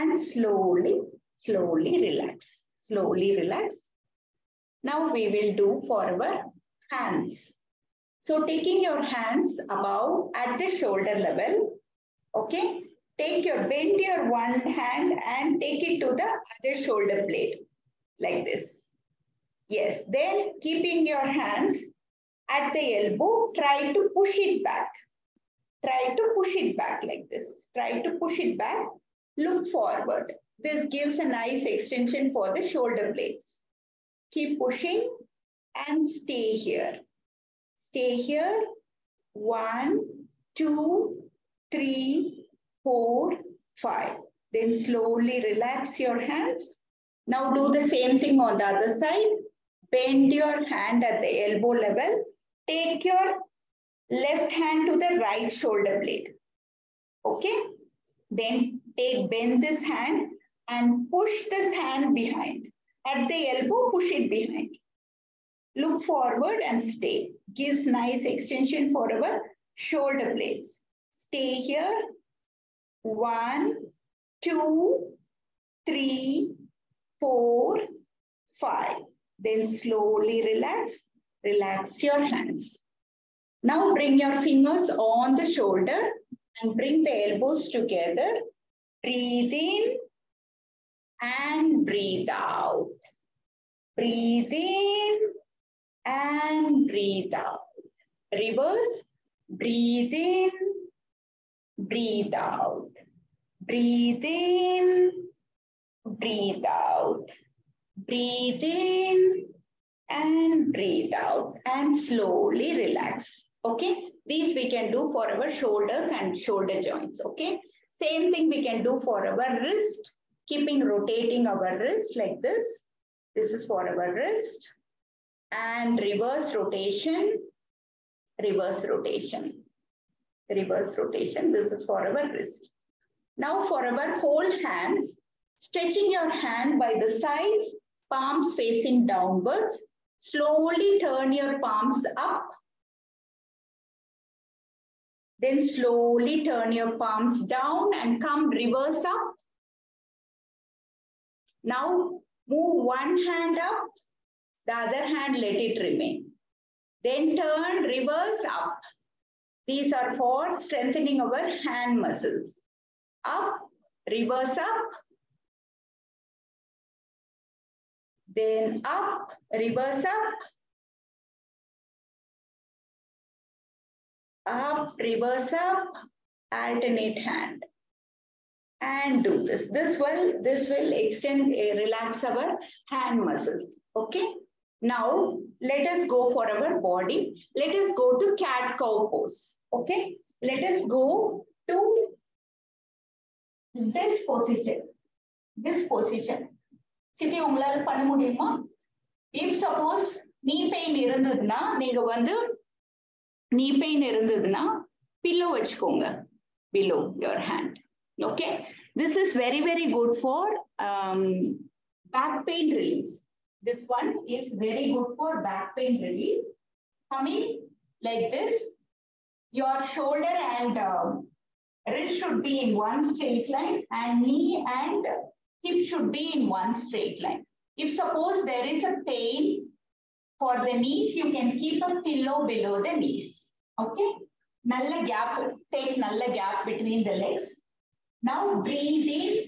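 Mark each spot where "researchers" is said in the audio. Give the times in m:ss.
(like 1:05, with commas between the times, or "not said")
not said.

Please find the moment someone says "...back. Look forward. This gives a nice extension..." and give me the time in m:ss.
0:28.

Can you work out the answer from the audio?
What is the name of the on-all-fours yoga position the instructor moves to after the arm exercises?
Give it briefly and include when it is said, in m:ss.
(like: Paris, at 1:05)
Cat-cow pose, at 3:08.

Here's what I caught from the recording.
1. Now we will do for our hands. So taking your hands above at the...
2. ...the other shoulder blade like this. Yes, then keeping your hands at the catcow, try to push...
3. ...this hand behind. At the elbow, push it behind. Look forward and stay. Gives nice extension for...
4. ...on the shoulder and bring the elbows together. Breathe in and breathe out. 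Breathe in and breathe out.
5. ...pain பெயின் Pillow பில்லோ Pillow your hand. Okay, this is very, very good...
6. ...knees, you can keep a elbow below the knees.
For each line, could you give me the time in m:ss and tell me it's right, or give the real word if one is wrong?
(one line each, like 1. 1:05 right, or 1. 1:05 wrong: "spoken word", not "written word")
1. 0:04 right
2. 0:16 wrong: "elbow", not "catcow"
3. 1:01 right
4. 1:24 right
5. 3:23 wrong: "Below", not "Pillow"
6. 3:50 wrong: "pillow", not "elbow".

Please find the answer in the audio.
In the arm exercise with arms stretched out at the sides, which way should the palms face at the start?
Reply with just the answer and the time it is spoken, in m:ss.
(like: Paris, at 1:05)
Downwards, at 2:18.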